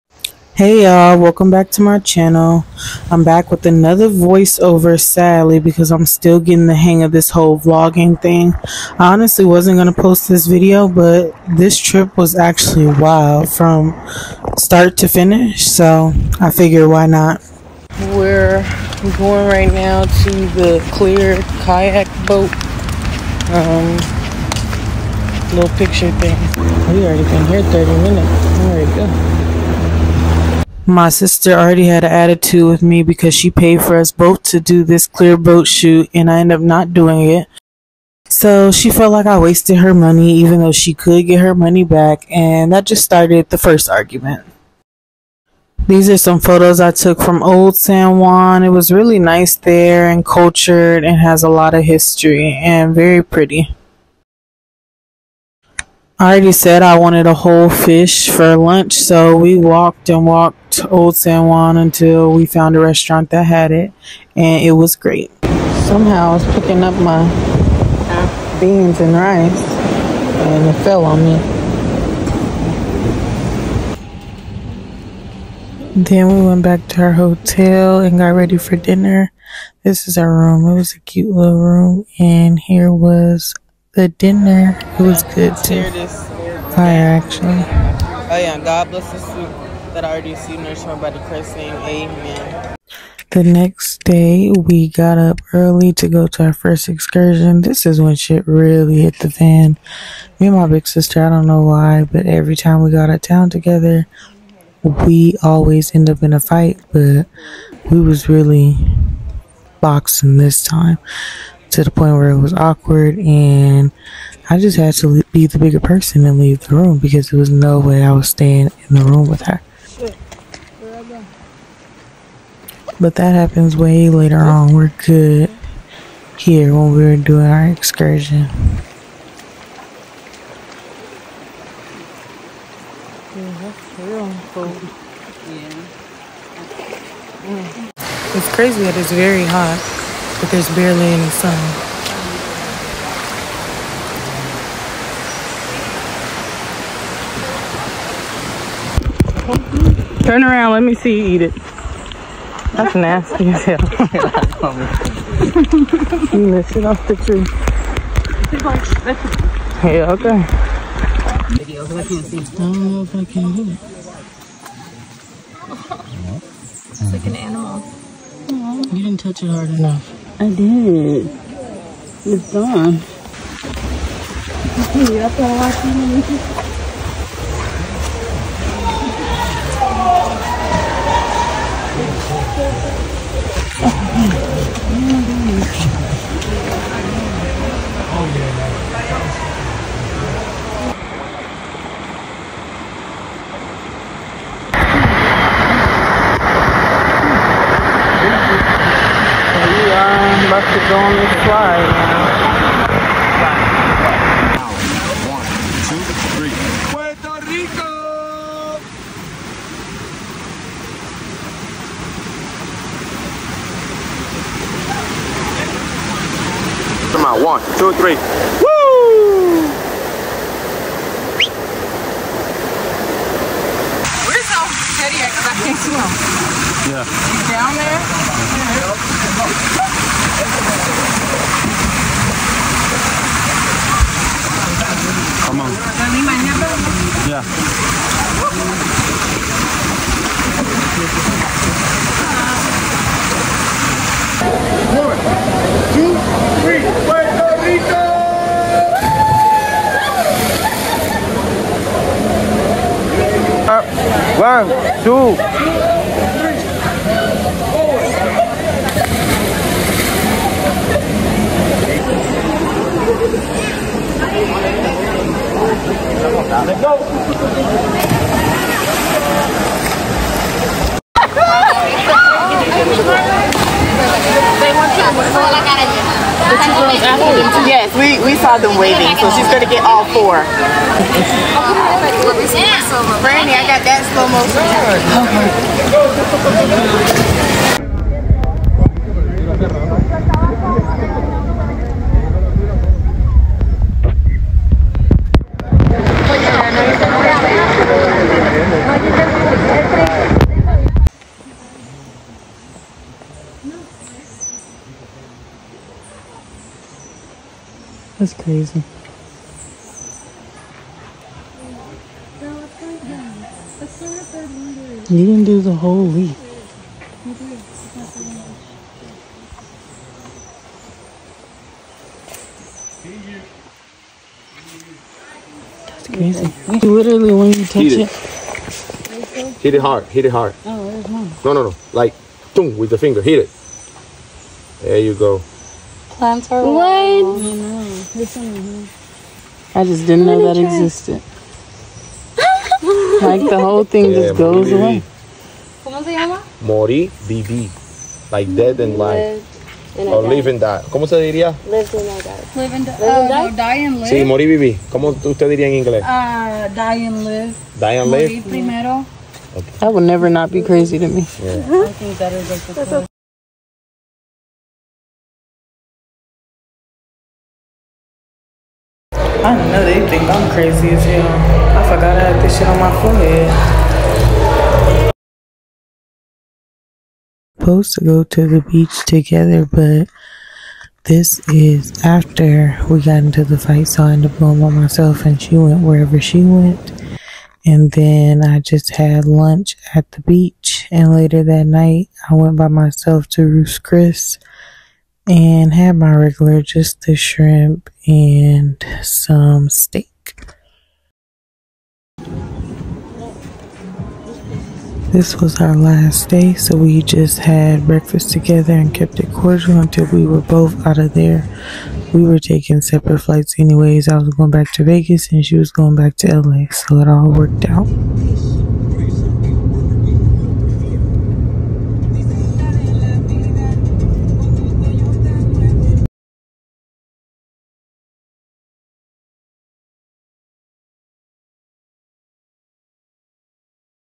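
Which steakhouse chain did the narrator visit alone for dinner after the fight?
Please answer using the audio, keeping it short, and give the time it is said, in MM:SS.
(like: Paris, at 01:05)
Ruth's Chris, at 06:33.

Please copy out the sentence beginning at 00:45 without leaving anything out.
These are some photos I took from Old San Juan.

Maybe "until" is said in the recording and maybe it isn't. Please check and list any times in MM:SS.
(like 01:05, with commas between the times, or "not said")
01:01, 06:49.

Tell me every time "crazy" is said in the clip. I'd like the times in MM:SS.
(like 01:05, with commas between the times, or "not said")
02:18, 05:08, 05:26, 06:00, 06:10.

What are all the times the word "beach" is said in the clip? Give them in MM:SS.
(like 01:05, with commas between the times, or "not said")
06:18, 06:30.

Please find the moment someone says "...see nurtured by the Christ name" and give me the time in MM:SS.
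01:30.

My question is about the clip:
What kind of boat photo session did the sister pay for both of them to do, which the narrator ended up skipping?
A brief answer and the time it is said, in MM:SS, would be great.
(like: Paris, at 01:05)
Clear boat shoot, at 00:35.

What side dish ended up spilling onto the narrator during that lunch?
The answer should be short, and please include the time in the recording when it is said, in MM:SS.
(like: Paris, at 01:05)
Beans and rice, at 01:08.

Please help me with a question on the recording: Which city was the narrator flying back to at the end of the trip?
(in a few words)
Vegas.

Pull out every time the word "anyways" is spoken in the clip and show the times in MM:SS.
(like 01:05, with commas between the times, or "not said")
06:53.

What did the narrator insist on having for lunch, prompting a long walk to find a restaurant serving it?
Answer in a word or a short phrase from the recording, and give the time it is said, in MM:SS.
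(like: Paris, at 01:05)
A whole fish, at 00:57.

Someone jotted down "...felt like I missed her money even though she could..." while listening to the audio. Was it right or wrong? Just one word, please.
wrong.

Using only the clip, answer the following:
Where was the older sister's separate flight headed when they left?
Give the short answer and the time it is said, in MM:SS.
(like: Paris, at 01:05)
LA, at 06:56.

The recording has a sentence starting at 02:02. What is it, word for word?
But that happens way later on.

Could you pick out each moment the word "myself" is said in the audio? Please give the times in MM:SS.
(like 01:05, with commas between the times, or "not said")
06:24, 06:32.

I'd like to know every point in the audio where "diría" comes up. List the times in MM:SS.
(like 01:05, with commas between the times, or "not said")
05:51, 05:55.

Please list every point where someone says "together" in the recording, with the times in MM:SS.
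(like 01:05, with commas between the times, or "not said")
01:43, 06:19, 06:48.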